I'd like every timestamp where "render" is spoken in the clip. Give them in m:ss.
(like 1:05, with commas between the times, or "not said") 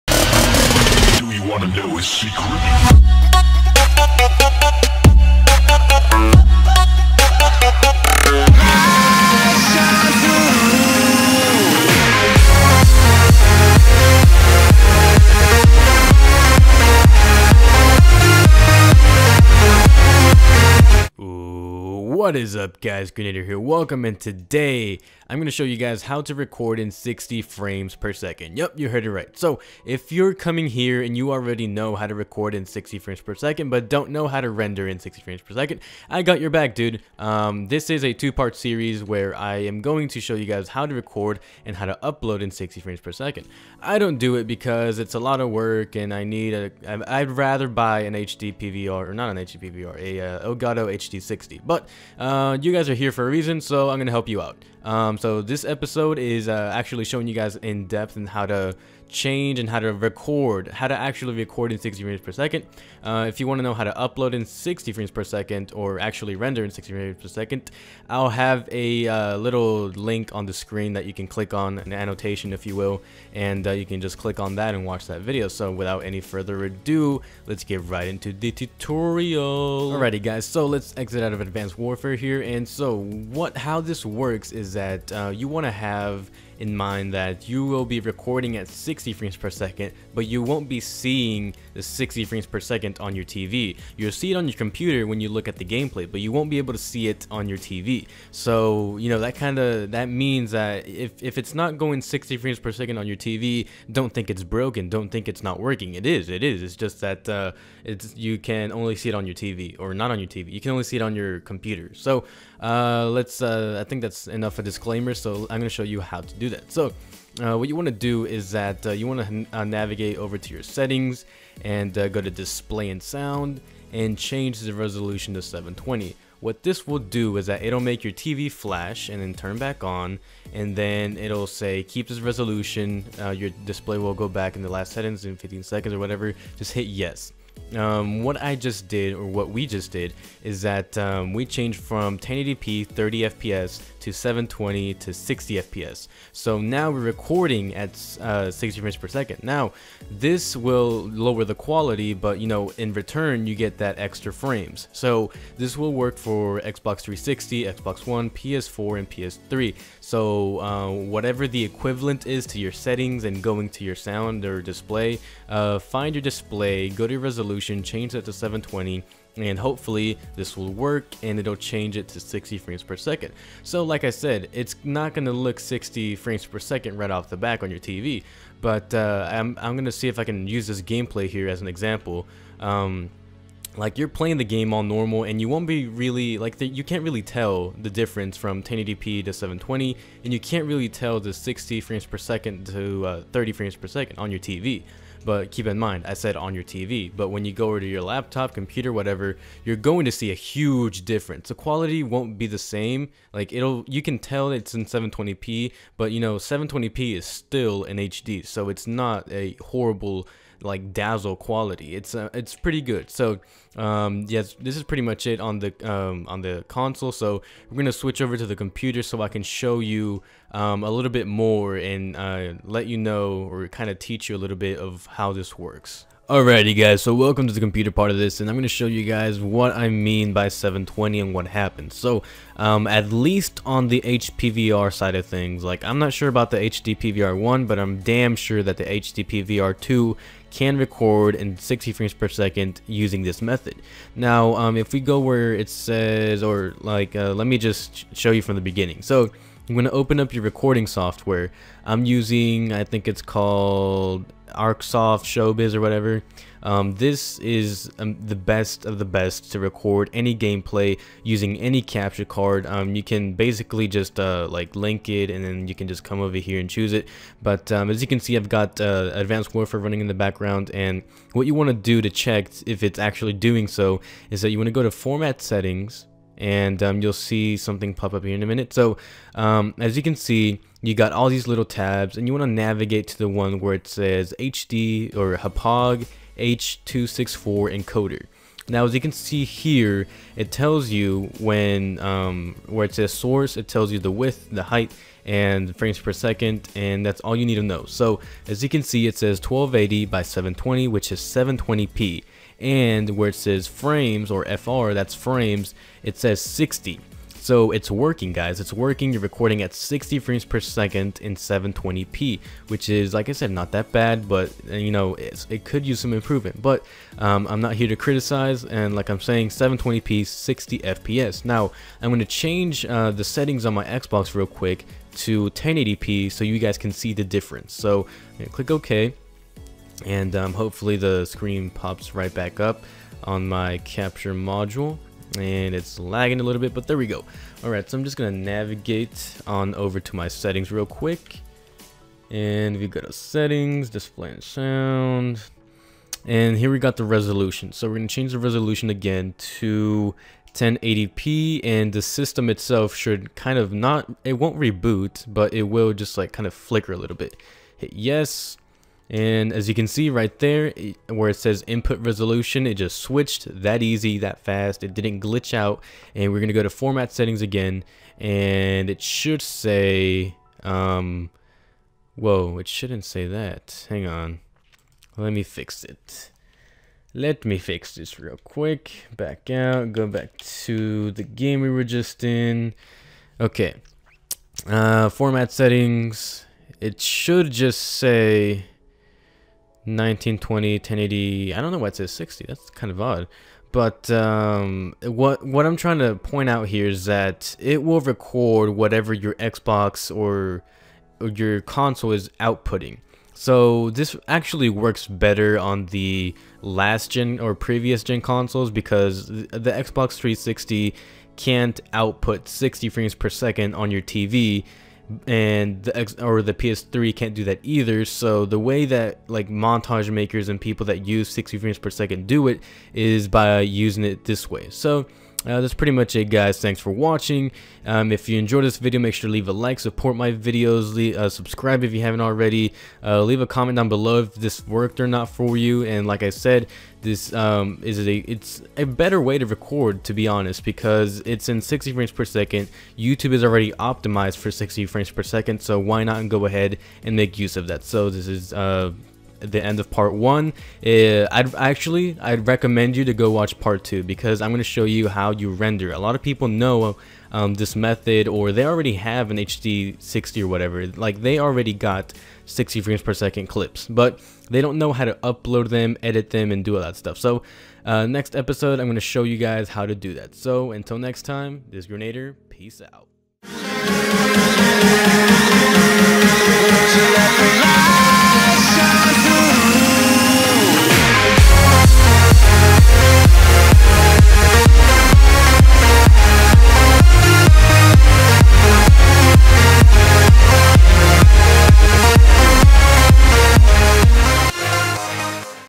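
0:34, 1:06, 7:35.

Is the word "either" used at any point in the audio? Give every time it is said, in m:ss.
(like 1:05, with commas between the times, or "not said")
6:57.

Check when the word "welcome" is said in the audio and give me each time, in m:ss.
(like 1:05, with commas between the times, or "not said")
0:23, 3:47.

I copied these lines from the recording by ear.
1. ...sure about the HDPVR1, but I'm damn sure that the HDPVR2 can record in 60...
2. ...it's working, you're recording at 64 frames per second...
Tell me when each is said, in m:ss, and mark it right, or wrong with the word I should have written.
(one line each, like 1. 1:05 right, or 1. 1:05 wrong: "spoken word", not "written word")
1. 3:56 right
2. 5:08 wrong: "60", not "64".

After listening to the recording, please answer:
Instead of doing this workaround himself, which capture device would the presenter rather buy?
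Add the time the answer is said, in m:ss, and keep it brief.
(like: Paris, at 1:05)
Elgato HD60, at 0:50.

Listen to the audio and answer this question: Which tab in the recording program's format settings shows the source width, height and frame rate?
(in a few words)
H264 encoder.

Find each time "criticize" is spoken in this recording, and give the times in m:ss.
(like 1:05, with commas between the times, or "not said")
5:17.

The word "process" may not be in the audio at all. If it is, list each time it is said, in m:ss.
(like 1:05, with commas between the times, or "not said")
not said.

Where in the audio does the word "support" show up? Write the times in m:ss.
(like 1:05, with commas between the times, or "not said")
7:09.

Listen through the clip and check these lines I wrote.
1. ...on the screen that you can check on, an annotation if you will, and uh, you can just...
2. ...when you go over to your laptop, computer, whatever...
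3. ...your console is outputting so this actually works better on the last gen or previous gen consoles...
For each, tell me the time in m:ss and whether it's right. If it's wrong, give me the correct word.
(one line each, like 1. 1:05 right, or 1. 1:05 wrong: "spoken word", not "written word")
1. 1:10 wrong: "click", not "check"
2. 3:17 right
3. 6:41 right.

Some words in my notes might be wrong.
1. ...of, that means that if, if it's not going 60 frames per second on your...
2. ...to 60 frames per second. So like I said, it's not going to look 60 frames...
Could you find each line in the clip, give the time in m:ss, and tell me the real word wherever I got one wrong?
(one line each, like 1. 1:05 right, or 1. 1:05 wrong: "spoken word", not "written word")
1. 1:39 right
2. 2:52 right.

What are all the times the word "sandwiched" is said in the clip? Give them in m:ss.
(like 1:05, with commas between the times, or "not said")
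not said.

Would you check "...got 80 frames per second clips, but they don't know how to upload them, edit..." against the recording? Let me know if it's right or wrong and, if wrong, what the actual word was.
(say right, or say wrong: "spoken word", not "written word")
wrong: "60", not "80".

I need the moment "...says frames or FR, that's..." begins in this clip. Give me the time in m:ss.
5:03.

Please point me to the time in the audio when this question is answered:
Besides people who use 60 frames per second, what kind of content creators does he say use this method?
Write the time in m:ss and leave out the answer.
6:59.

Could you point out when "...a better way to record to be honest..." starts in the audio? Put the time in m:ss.
7:18.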